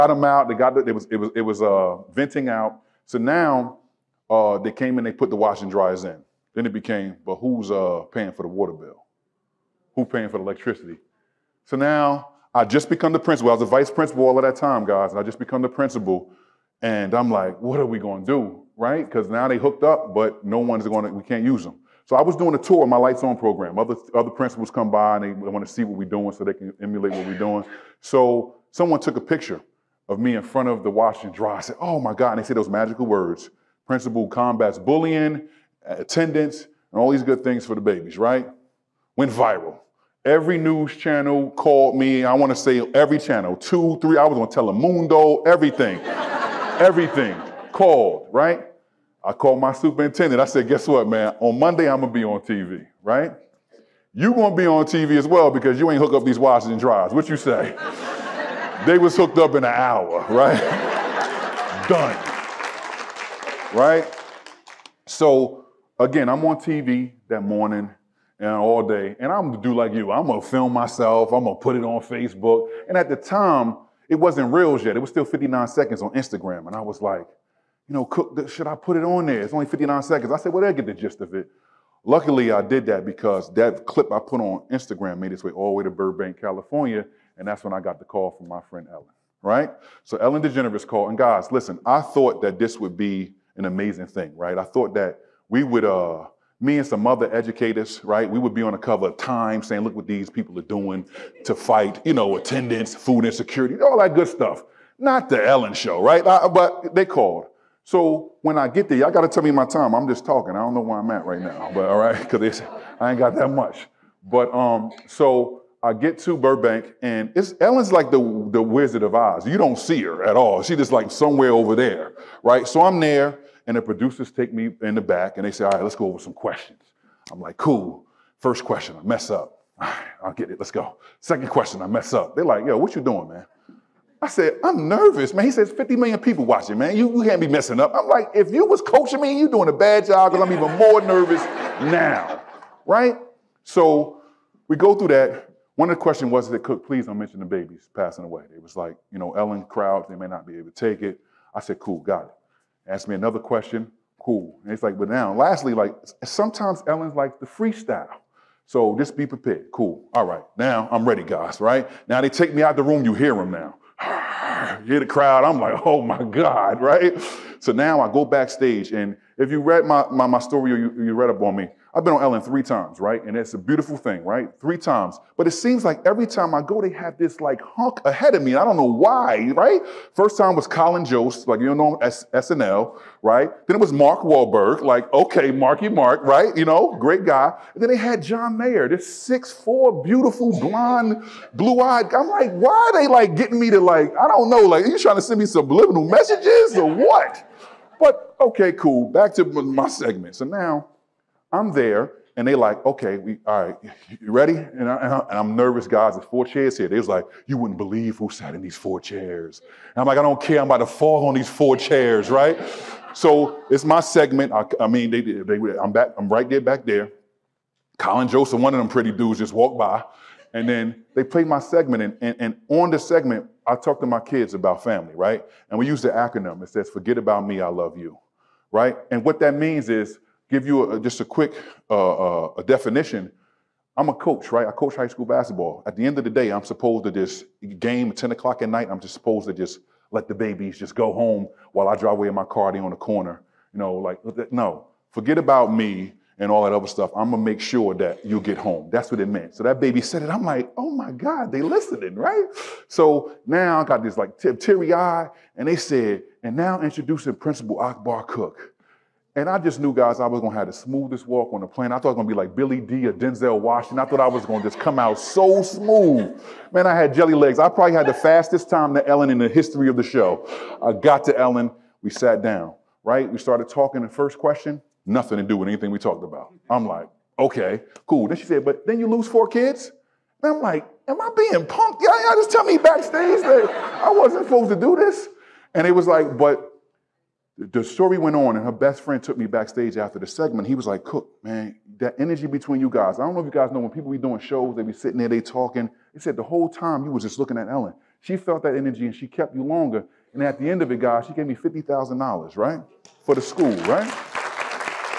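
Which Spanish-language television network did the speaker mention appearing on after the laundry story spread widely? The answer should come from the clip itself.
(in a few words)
Telemundo.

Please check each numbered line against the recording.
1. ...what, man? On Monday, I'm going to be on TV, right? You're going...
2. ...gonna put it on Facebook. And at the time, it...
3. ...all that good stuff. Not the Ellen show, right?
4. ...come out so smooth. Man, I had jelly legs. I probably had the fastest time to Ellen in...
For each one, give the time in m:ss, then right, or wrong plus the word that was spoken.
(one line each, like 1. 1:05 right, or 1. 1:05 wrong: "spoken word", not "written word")
1. 0:50 right
2. 1:11 right
3. 1:43 right
4. 4:24 right.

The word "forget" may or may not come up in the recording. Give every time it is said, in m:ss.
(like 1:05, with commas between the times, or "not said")
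3:46, 4:05.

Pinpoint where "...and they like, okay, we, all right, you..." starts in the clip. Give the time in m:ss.
3:22.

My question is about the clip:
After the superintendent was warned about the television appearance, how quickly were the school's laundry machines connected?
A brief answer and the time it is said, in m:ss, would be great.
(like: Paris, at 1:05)
in an hour, at 0:59.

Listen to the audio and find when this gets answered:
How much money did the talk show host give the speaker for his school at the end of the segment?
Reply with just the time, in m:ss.
5:01.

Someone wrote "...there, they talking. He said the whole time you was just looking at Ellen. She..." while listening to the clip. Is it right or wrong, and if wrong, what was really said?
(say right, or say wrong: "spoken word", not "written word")
right.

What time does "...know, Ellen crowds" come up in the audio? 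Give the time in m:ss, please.
2:29.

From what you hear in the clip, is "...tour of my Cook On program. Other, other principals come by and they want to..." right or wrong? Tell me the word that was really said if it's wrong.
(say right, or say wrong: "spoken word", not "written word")
wrong: "Lights", not "Cook".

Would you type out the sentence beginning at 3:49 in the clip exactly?
And what that means is give you a, just a quick uh, uh, a definition.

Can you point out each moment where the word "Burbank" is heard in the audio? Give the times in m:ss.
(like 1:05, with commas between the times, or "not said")
1:25, 1:56.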